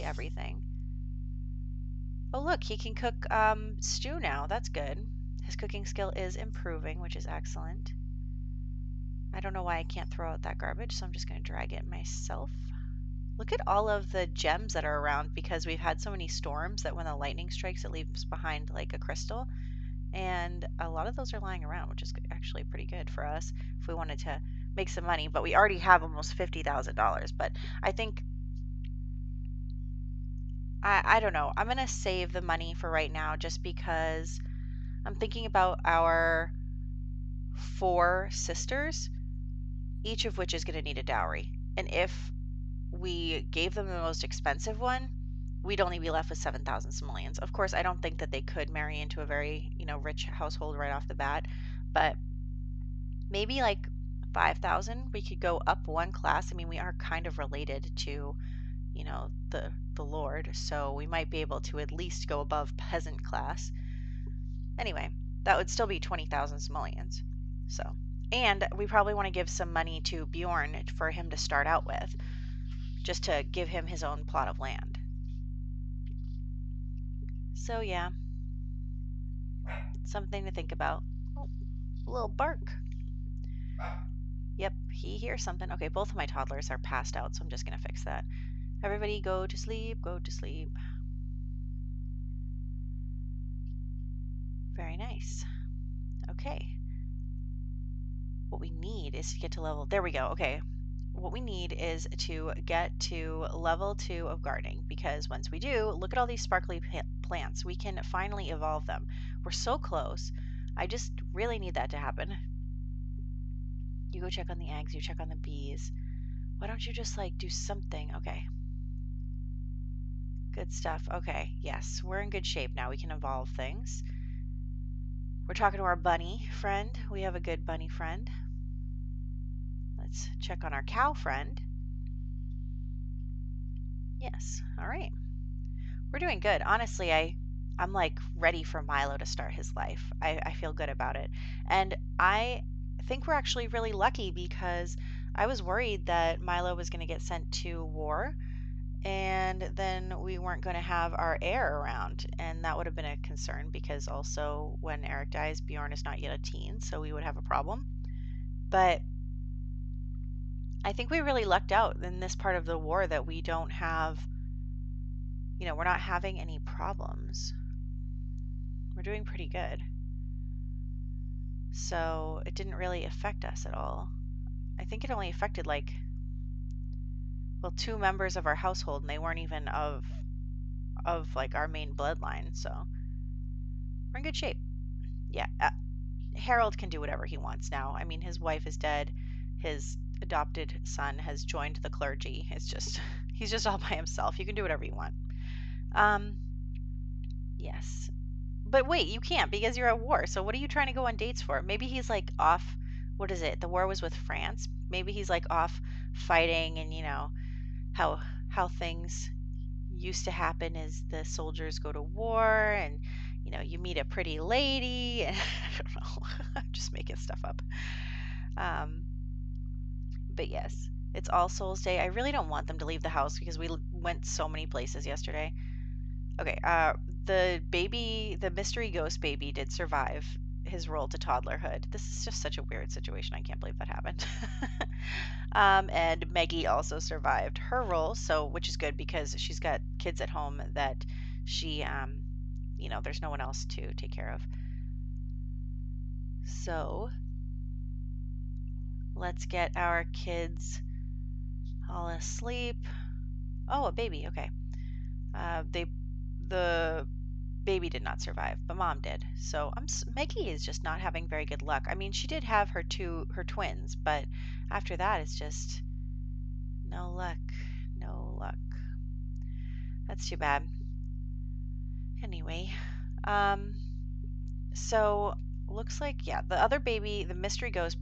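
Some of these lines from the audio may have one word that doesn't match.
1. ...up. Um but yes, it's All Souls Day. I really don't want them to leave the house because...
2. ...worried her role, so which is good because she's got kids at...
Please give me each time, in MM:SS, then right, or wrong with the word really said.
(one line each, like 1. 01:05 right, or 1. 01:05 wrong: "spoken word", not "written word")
1. 03:37 right
2. 03:56 wrong: "survived", not "worried".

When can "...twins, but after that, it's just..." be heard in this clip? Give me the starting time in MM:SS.
04:23.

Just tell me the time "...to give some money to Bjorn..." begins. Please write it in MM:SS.
01:09.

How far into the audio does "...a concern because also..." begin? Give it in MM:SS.
02:33.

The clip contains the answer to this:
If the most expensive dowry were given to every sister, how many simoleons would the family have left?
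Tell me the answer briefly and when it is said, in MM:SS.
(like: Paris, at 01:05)
7,000, at 00:46.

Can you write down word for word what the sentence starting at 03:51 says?
This is just such a weird situation.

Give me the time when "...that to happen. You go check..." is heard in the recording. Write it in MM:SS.
01:51.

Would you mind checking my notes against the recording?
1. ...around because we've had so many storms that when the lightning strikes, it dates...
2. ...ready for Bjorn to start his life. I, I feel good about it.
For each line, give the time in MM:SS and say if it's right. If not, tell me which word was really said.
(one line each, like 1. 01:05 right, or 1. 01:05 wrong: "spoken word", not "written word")
1. 00:15 wrong: "leaves", not "dates"
2. 02:18 wrong: "Milo", not "Bjorn".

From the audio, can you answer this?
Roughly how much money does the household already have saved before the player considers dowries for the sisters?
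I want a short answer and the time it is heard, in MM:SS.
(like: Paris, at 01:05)
$50,000, at 00:26.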